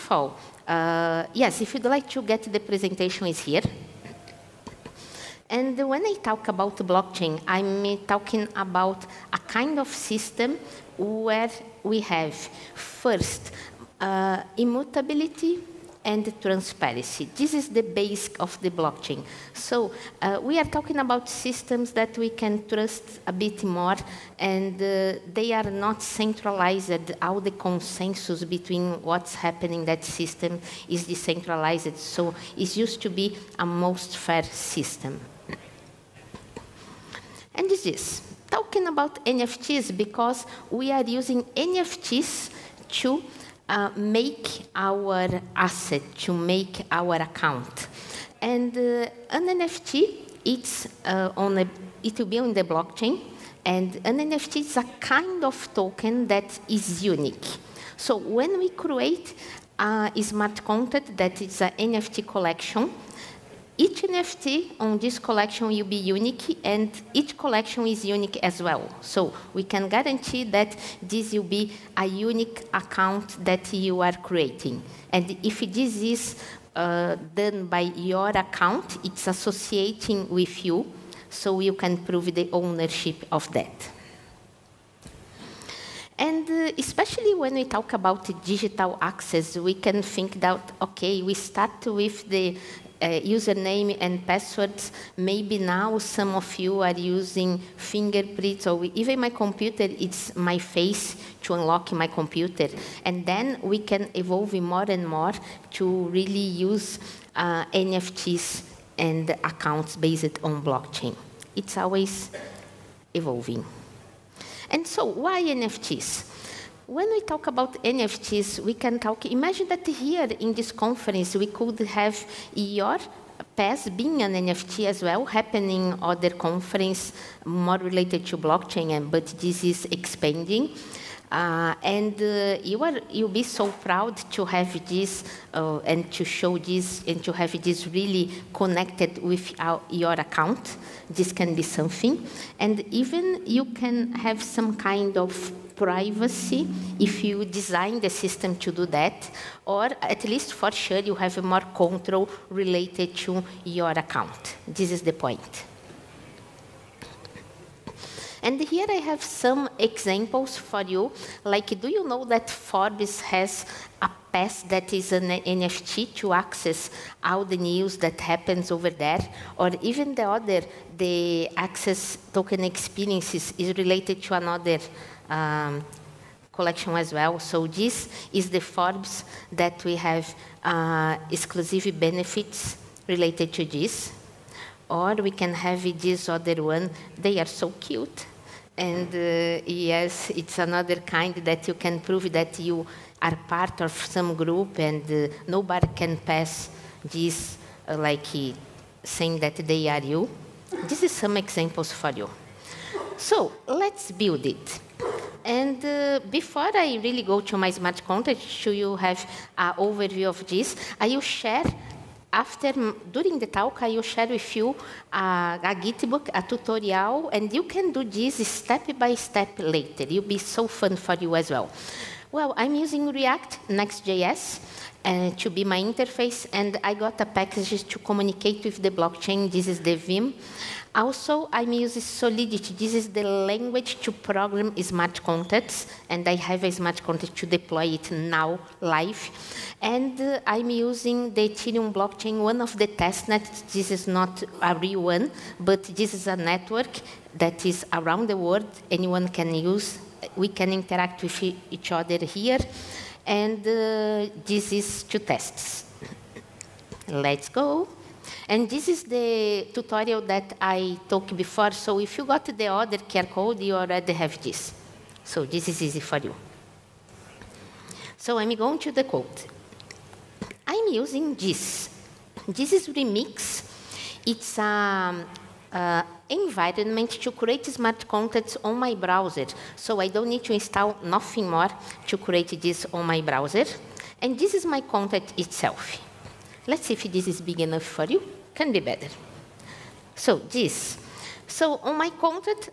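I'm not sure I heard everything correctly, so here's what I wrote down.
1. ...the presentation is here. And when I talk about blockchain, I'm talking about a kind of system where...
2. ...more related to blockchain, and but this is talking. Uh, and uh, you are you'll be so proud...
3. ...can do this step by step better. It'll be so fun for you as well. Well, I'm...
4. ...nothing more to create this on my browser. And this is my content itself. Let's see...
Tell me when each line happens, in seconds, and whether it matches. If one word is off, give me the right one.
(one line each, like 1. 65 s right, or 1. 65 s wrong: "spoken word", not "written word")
1. 2 s right
2. 127 s wrong: "expanding", not "talking"
3. 217 s wrong: "later", not "better"
4. 281 s right.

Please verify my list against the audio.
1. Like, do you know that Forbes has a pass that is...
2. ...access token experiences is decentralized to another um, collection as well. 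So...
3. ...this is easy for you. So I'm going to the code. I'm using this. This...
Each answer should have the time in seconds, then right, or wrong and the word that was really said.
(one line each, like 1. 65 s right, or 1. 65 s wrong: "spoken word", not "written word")
1. 161 s right
2. 171 s wrong: "related", not "decentralized"
3. 265 s right.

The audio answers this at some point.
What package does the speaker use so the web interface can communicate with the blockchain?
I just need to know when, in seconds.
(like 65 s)
229 s.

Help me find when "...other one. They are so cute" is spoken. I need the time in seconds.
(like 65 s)
186 s.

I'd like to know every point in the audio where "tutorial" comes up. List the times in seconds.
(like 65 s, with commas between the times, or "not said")
216 s, 259 s.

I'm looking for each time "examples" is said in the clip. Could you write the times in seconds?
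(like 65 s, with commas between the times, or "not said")
159 s, 201 s.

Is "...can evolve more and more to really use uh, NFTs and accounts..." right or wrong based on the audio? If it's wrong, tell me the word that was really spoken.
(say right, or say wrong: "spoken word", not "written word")
right.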